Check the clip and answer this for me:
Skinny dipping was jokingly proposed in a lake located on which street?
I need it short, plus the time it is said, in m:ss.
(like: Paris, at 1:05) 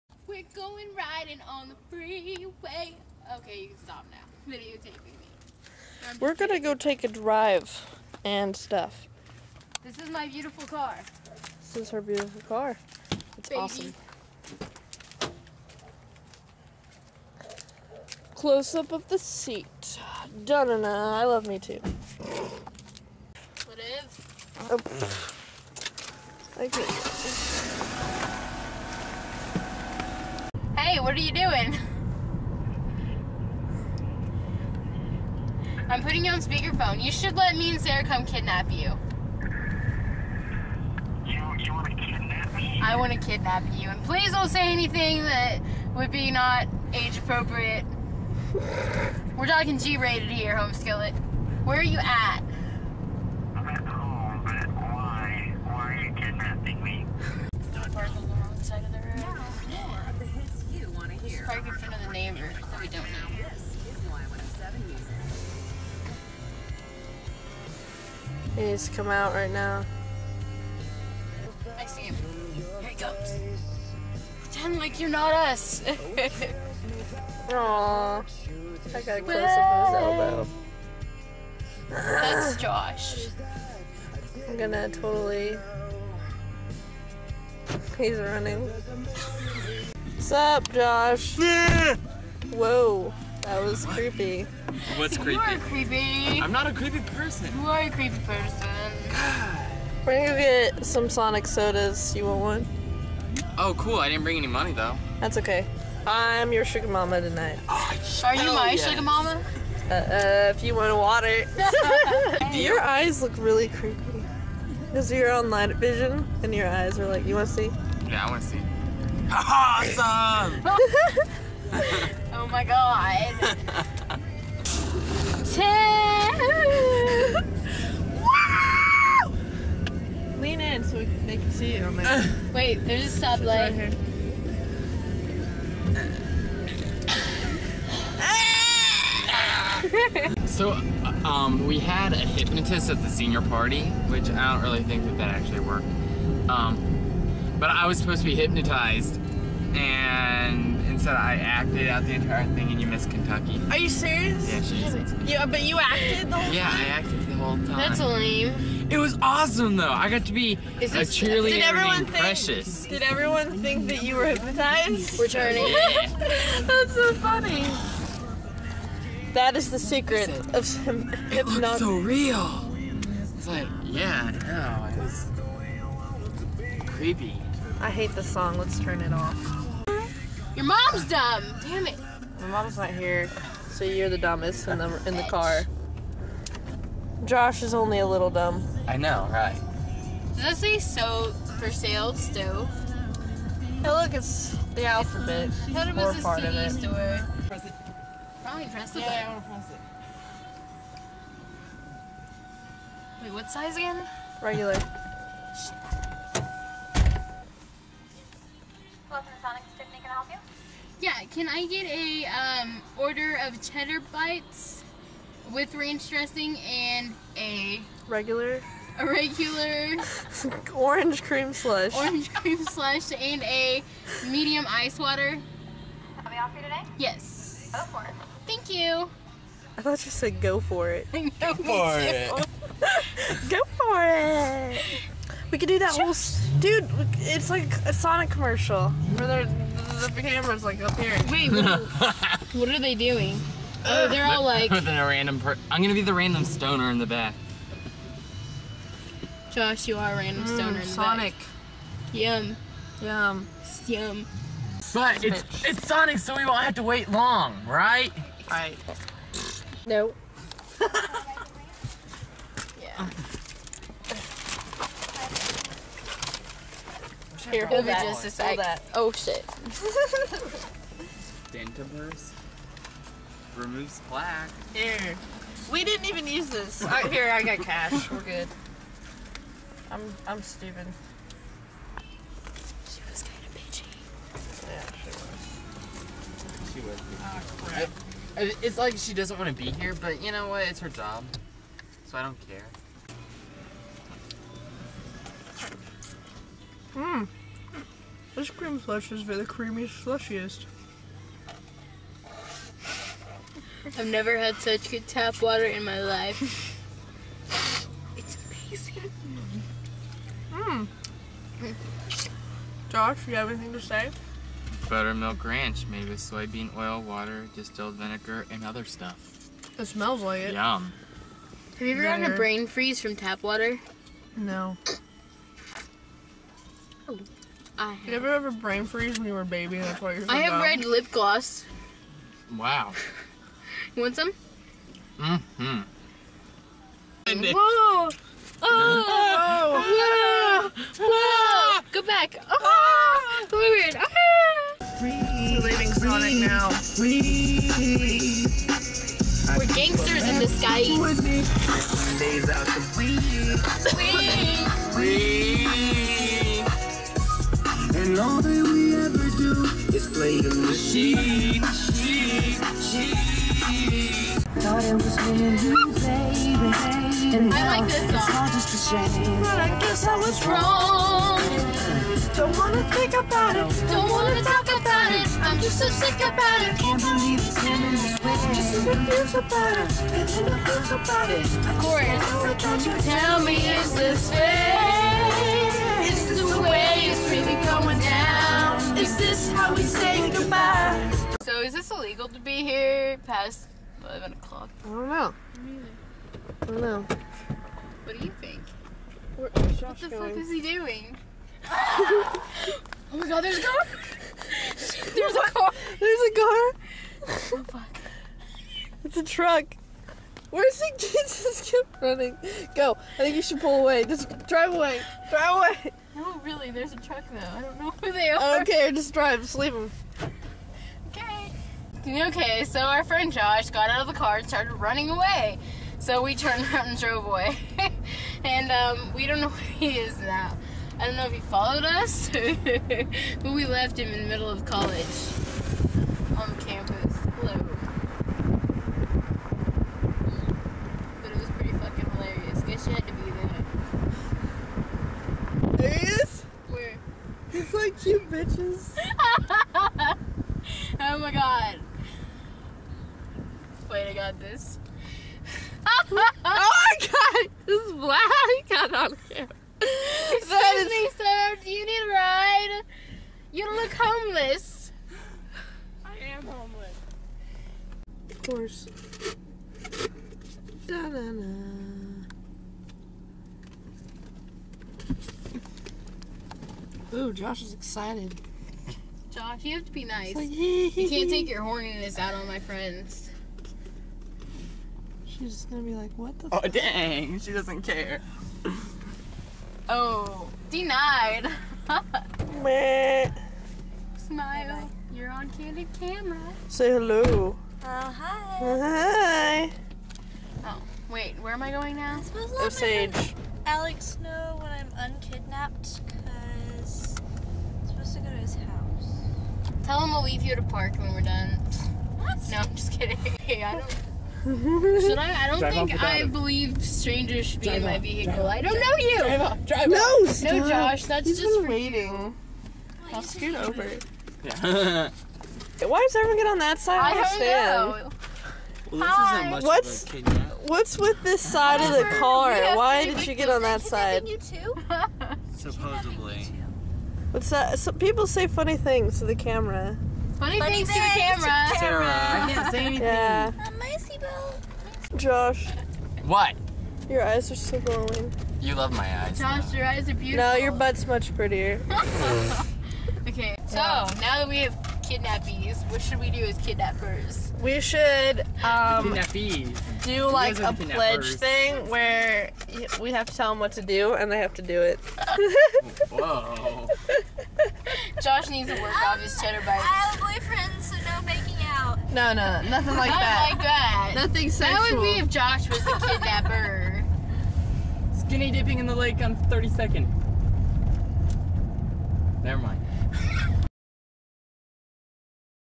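32nd, at 9:39.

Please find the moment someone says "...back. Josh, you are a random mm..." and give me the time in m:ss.
4:07.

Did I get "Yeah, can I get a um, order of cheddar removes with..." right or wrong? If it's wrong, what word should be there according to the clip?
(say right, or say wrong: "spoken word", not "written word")
wrong: "bites", not "removes".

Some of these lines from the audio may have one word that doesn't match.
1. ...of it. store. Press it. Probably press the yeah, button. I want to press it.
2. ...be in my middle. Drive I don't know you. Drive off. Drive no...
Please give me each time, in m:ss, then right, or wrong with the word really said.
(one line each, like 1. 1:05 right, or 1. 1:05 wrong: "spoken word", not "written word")
1. 3:16 right
2. 8:37 wrong: "vehicle", not "middle".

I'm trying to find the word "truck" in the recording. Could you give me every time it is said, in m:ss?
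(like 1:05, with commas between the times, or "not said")
6:49, 6:56.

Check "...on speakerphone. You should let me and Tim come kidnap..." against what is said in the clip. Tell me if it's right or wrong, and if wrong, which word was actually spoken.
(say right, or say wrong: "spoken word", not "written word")
wrong: "Sarah", not "Tim".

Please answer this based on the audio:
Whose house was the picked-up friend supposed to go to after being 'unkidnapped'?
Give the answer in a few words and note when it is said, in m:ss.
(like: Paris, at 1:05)
Alex's, at 8:23.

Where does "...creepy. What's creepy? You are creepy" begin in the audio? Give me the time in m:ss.
1:33.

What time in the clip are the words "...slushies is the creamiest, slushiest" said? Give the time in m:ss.
4:58.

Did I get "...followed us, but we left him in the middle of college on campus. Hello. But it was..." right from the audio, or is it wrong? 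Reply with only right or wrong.
right.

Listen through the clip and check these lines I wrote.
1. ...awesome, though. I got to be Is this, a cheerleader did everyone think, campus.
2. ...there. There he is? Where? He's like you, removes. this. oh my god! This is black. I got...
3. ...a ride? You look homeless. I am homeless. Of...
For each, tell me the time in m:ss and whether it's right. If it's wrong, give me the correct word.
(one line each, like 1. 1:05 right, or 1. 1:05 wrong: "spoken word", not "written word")
1. 2:39 wrong: "precious", not "campus"
2. 7:25 wrong: "bitches", not "removes"
3. 7:41 right.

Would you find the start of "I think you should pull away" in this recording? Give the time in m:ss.
6:53.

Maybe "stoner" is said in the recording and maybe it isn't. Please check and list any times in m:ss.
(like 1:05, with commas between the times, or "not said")
4:06, 4:10.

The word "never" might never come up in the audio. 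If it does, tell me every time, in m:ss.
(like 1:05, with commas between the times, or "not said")
5:04, 9:42.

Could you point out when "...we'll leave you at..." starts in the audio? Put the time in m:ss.
8:30.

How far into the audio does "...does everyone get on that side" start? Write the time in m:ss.
8:46.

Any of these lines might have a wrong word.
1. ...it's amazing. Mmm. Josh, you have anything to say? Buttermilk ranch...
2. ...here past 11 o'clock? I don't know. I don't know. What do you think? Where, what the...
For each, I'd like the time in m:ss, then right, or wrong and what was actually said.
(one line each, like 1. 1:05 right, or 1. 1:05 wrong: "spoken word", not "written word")
1. 5:08 right
2. 6:32 right.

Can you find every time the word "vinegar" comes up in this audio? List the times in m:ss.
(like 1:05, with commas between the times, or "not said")
5:17.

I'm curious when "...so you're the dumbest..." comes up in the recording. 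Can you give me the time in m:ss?
3:03.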